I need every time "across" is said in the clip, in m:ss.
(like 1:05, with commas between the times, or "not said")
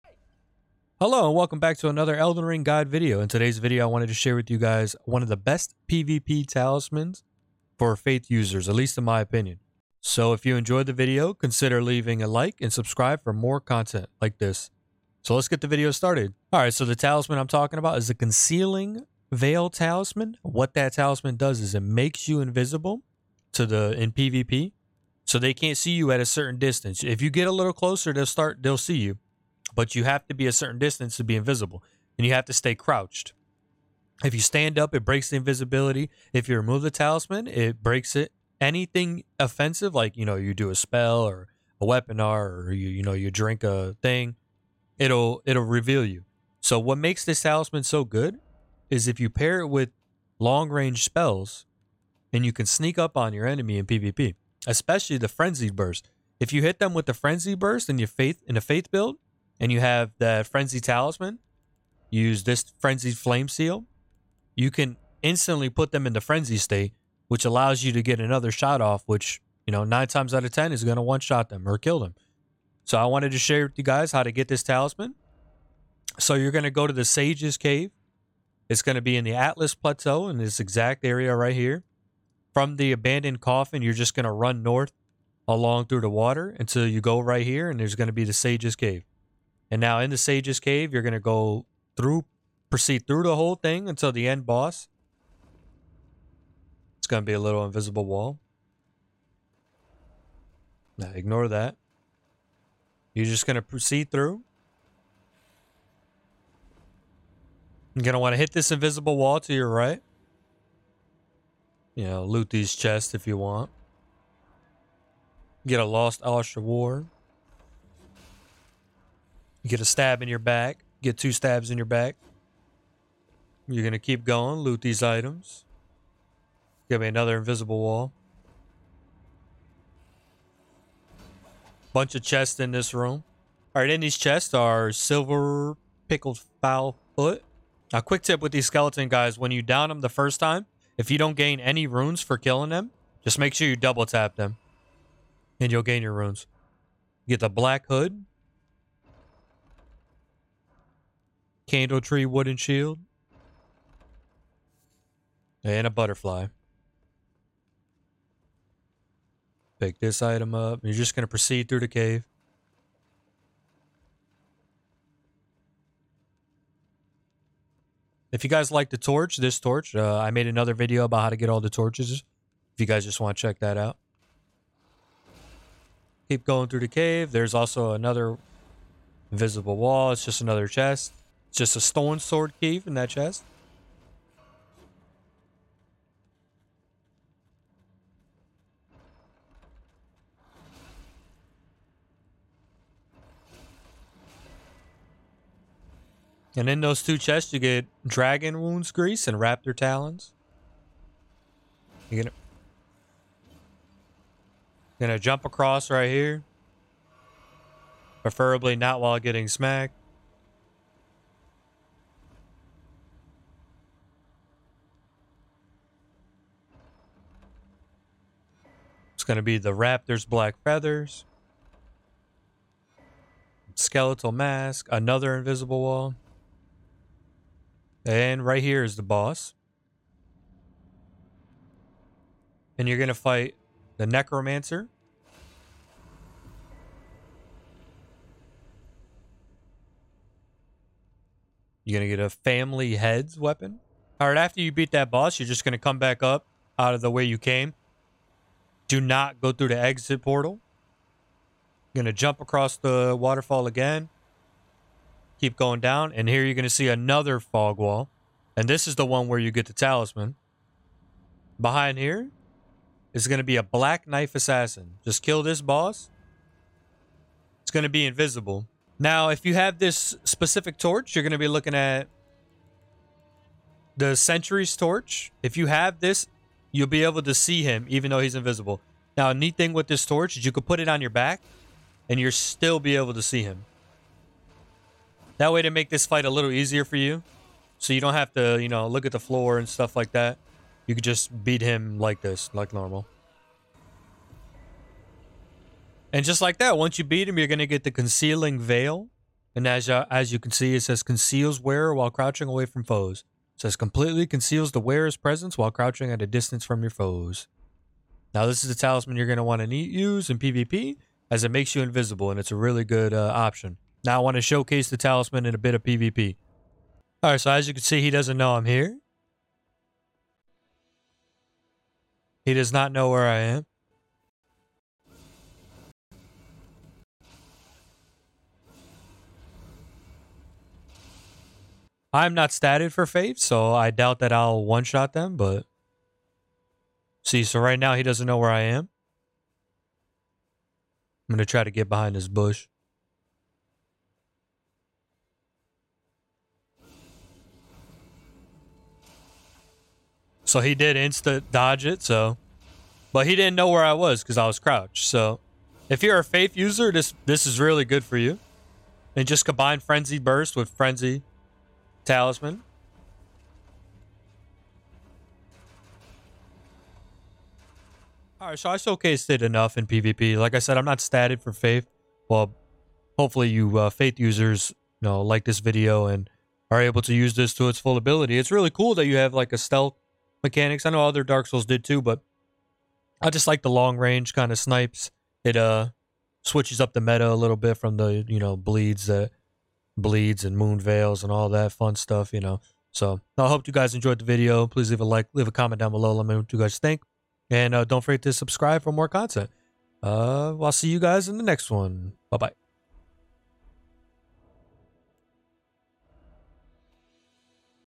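3:25, 4:12.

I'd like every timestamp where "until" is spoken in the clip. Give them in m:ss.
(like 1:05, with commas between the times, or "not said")
1:26, 1:33.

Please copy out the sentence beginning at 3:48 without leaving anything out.
And right here is the boss.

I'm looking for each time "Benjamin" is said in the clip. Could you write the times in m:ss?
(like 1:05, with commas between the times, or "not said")
not said.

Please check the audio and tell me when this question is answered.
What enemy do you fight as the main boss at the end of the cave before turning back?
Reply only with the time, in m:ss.
3:54.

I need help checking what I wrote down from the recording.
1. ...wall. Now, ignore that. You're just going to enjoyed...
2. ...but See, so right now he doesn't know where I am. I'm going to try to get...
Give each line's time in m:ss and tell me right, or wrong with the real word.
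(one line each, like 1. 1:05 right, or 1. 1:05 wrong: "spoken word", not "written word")
1. 1:38 wrong: "proceed", not "enjoyed"
2. 5:35 right.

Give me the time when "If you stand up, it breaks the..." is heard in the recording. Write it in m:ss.
0:34.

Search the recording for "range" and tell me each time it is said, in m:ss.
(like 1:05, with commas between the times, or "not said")
0:50, 6:23.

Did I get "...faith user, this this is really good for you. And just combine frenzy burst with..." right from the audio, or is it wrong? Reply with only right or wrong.
right.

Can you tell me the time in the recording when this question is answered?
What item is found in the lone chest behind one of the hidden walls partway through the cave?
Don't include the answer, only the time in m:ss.
3:01.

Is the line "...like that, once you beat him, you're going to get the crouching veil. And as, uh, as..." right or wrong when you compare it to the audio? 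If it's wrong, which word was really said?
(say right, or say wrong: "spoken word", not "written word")
wrong: "concealing", not "crouching".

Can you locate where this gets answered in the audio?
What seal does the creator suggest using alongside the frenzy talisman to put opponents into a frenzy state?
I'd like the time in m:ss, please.
1:02.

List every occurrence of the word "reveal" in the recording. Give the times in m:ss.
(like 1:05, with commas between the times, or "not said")
0:45.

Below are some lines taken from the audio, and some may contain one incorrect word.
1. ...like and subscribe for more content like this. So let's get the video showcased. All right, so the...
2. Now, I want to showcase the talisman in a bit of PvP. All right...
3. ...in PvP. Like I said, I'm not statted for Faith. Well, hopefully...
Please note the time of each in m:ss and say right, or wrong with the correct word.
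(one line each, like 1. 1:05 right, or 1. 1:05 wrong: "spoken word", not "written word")
1. 0:12 wrong: "started", not "showcased"
2. 5:14 right
3. 6:09 right.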